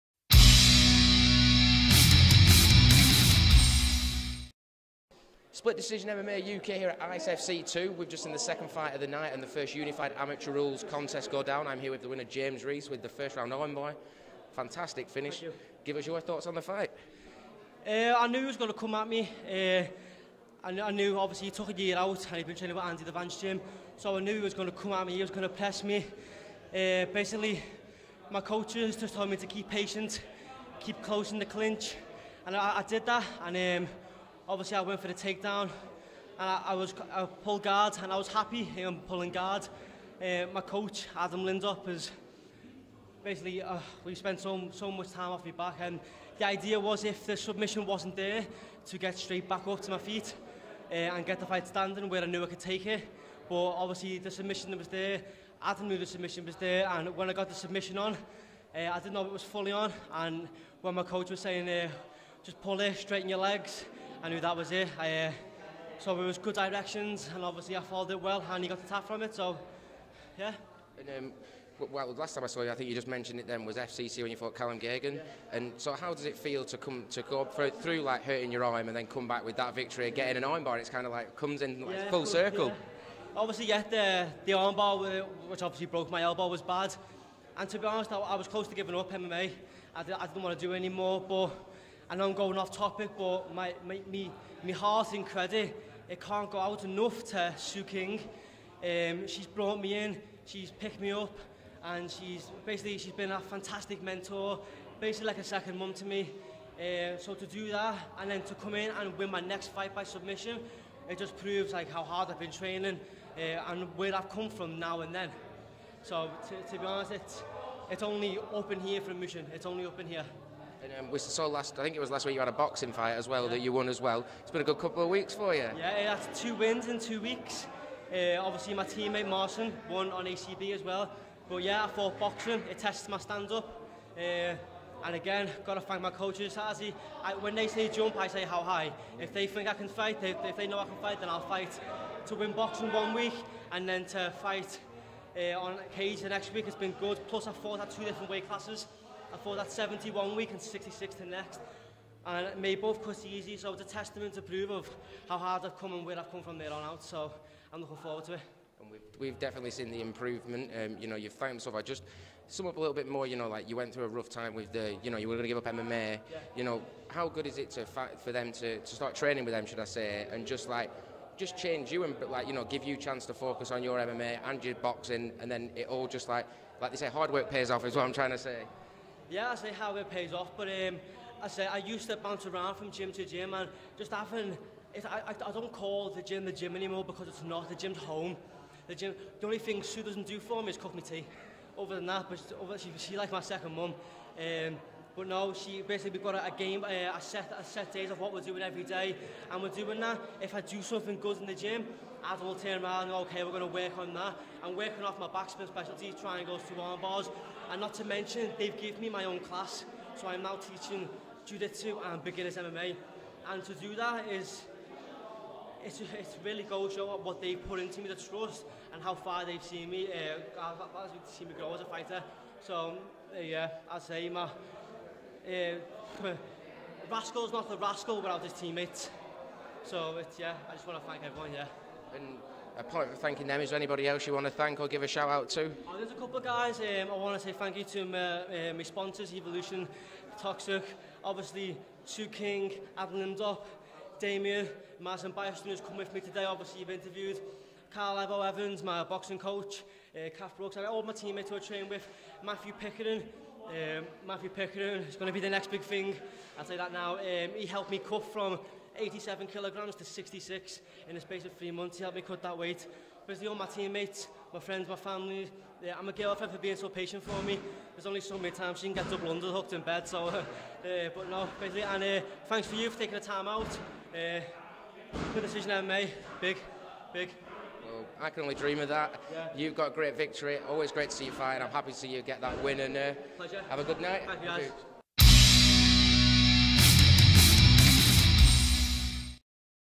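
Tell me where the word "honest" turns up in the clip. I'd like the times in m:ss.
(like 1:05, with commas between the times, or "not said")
1:27, 1:56.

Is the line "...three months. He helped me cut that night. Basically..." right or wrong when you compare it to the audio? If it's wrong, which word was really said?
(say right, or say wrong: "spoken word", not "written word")
wrong: "weight", not "night".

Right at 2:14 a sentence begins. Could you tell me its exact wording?
Uh, and again, got to thank my coaches.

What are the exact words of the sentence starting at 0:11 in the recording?
I'm here with the winner, James Reece, with the first round Owen boy.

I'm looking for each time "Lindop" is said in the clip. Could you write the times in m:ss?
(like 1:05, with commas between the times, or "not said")
0:41, 4:03.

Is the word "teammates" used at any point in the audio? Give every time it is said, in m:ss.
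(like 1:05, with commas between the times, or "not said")
2:08, 3:48, 4:11, 4:23.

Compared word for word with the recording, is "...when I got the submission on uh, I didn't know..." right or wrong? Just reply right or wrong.
right.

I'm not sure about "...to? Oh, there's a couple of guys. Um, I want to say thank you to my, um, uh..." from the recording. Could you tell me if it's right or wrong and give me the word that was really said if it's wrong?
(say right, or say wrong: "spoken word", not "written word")
right.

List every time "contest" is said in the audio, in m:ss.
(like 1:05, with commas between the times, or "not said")
0:10.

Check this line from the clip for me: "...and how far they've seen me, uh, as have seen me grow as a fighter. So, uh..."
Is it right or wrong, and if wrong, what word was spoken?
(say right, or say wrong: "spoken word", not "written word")
right.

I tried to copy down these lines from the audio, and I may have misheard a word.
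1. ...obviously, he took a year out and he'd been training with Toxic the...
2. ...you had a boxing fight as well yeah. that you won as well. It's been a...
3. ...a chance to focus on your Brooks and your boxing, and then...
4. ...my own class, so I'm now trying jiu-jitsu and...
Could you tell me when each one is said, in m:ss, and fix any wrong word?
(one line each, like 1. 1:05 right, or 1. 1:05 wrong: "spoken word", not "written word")
1. 0:21 wrong: "Andy", not "Toxic"
2. 2:02 right
3. 2:52 wrong: "MMA", not "Brooks"
4. 3:29 wrong: "teaching", not "trying".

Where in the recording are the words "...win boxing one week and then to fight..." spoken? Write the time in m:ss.
2:22.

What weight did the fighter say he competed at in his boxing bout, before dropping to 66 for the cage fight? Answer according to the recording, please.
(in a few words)
71.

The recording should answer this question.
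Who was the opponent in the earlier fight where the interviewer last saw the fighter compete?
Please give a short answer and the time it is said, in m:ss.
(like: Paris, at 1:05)
Callum Gagan, at 1:14.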